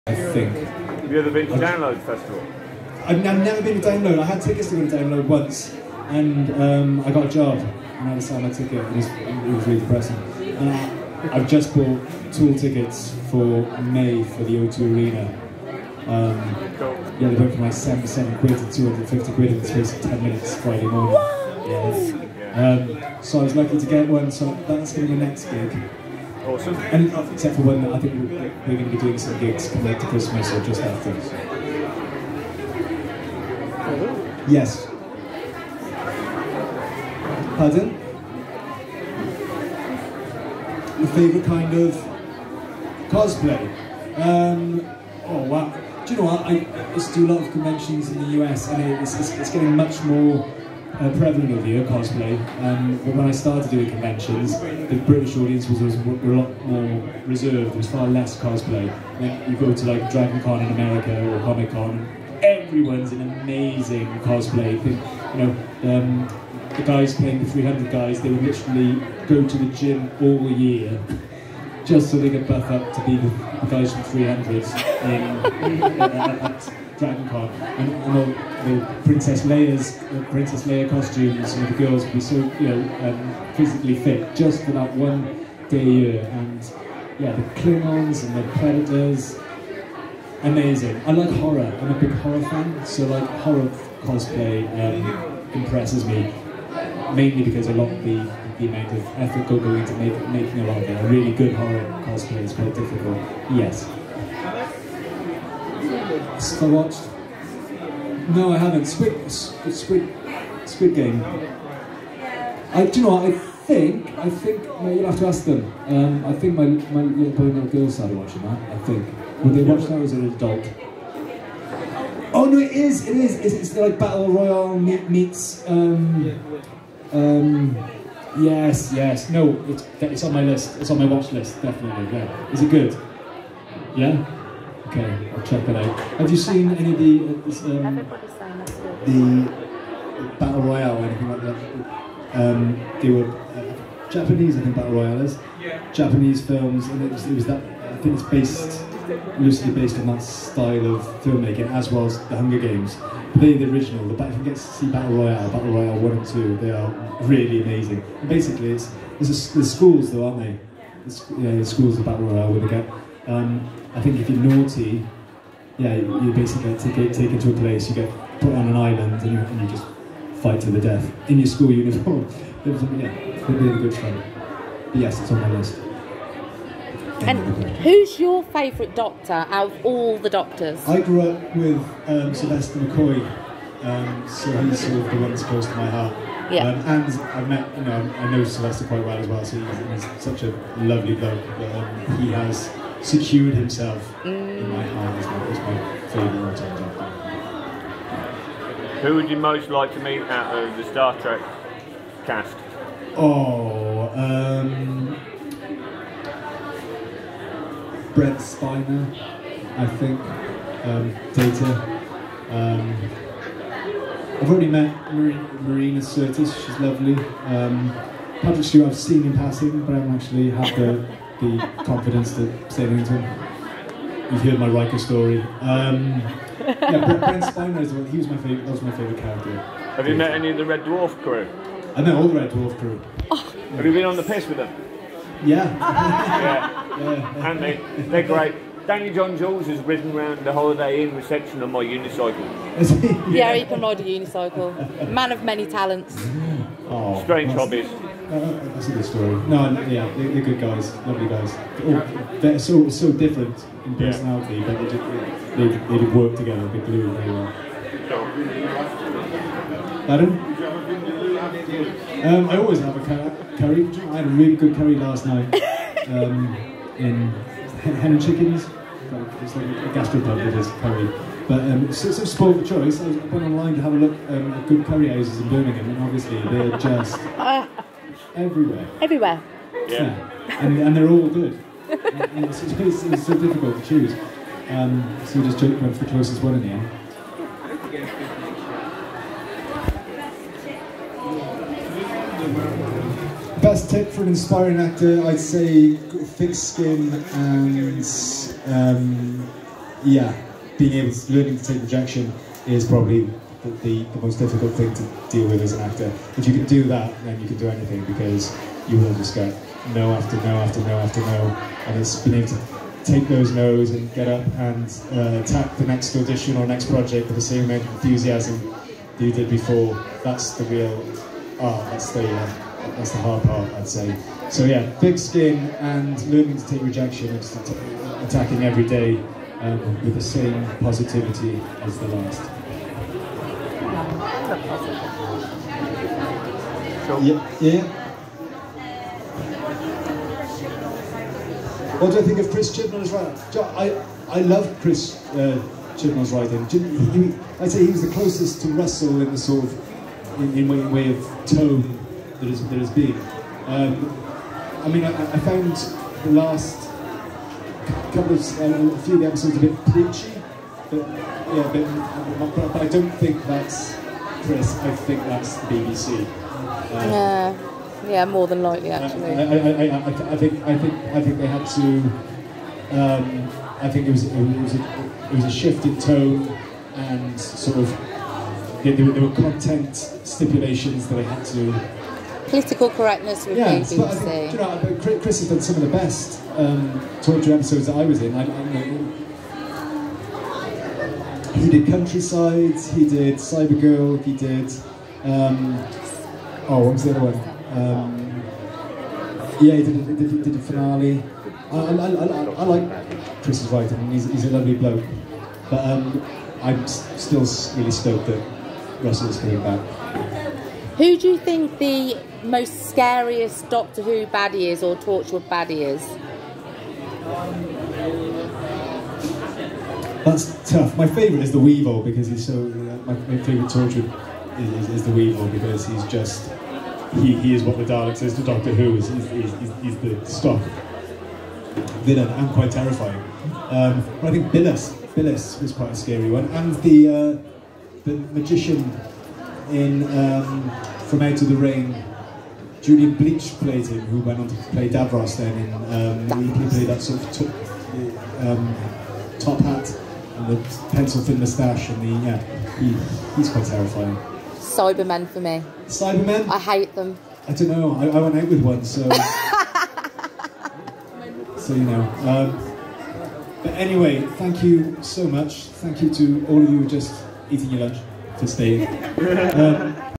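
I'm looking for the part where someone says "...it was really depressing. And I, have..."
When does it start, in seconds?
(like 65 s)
9 s.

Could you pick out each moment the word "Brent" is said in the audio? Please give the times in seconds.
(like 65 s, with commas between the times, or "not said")
208 s, 227 s.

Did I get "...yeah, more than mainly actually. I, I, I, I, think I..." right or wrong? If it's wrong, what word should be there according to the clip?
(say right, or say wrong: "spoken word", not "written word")
wrong: "likely", not "mainly".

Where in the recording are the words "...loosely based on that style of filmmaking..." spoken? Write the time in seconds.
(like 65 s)
149 s.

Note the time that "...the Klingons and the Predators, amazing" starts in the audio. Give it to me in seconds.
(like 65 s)
87 s.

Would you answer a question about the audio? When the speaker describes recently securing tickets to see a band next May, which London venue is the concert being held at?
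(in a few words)
O2 Arena.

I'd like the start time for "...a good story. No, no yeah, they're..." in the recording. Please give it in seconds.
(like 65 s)
248 s.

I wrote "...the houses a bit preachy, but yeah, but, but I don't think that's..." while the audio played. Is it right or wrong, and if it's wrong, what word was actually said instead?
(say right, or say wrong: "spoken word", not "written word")
wrong: "episodes", not "houses".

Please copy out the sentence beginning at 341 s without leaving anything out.
What do I think of Chris Chibnall's writing?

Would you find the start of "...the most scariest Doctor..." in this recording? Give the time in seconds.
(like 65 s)
411 s.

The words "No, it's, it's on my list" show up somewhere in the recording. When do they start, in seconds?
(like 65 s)
129 s.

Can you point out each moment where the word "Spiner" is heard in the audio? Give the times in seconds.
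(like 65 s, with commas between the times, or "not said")
208 s, 227 s.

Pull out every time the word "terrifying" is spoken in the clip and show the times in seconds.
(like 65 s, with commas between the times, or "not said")
432 s, 453 s.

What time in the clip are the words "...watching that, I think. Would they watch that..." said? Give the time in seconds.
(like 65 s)
118 s.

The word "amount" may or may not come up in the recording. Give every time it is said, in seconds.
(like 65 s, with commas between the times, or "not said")
98 s, 317 s.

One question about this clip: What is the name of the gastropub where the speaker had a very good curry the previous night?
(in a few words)
Hen and Chickens.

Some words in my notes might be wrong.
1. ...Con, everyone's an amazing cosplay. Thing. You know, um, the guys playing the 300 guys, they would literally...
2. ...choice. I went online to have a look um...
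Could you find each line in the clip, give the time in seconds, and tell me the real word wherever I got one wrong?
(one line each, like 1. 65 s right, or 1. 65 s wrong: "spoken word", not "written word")
1. 61 s right
2. 272 s right.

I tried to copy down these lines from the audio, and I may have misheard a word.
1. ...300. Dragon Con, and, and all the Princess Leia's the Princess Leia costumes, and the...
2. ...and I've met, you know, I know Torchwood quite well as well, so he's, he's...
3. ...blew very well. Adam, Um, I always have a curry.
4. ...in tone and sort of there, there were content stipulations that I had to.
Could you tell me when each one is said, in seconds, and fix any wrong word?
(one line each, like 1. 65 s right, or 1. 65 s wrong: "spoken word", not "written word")
1. 74 s right
2. 186 s wrong: "Sylvester", not "Torchwood"
3. 256 s right
4. 375 s right.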